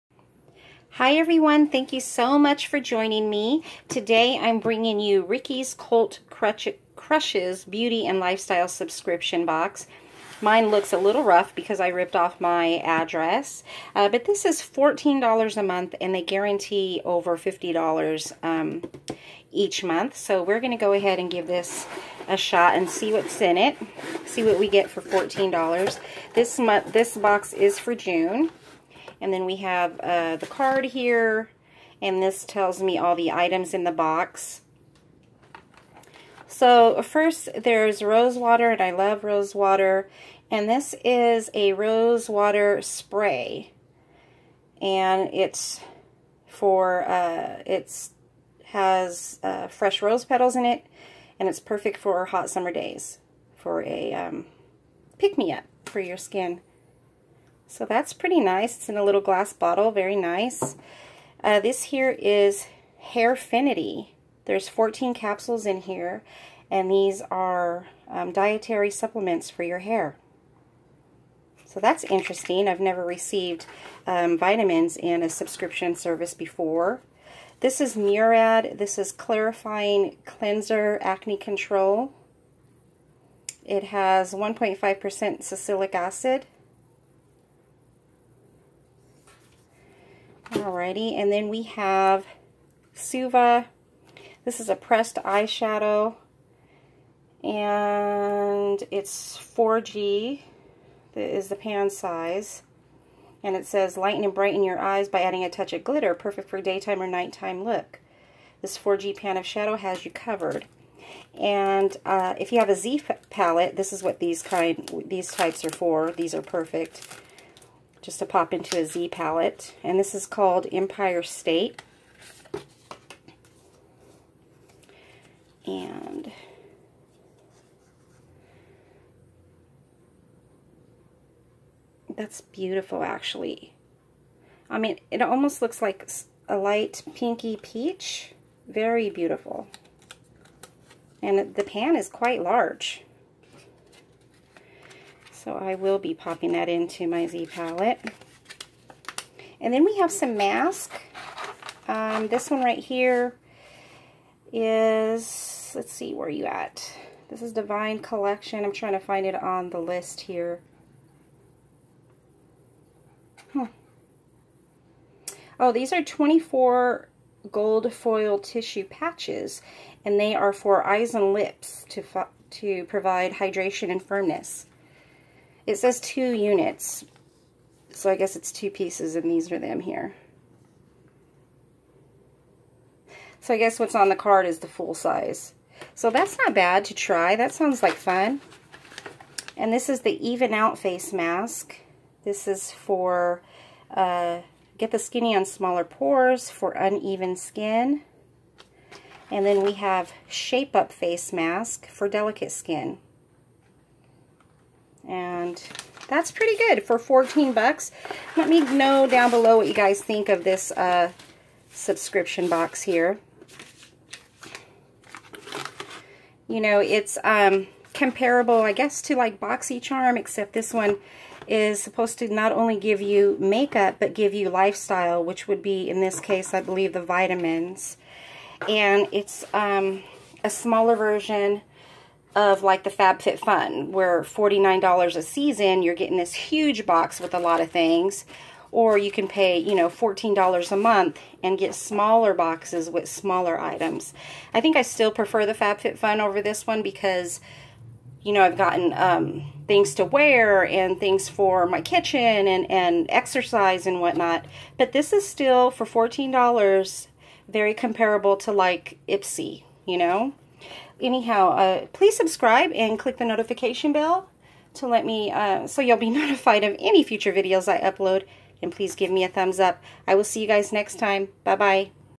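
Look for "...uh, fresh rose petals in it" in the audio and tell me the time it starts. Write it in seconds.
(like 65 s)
49 s.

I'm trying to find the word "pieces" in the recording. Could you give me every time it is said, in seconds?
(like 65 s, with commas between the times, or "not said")
178 s.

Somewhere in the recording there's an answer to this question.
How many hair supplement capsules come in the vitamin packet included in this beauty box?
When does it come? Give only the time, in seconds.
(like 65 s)
64 s.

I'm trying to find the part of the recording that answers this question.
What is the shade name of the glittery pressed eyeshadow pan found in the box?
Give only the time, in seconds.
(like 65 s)
120 s.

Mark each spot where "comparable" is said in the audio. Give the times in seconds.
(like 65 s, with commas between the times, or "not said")
217 s, 257 s.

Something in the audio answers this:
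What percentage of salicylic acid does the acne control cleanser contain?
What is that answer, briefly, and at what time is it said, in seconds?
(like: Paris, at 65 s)
1.5%, at 84 s.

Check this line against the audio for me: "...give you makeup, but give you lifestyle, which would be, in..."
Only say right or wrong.
right.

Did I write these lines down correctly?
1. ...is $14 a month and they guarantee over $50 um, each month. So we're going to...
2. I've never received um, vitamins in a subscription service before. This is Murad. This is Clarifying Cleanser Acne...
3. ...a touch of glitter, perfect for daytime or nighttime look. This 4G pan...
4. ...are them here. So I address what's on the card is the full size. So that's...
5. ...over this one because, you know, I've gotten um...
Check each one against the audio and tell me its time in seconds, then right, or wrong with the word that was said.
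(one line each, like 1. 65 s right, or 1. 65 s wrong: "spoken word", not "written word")
1. 14 s right
2. 72 s right
3. 105 s right
4. 179 s wrong: "guess", not "address"
5. 246 s right.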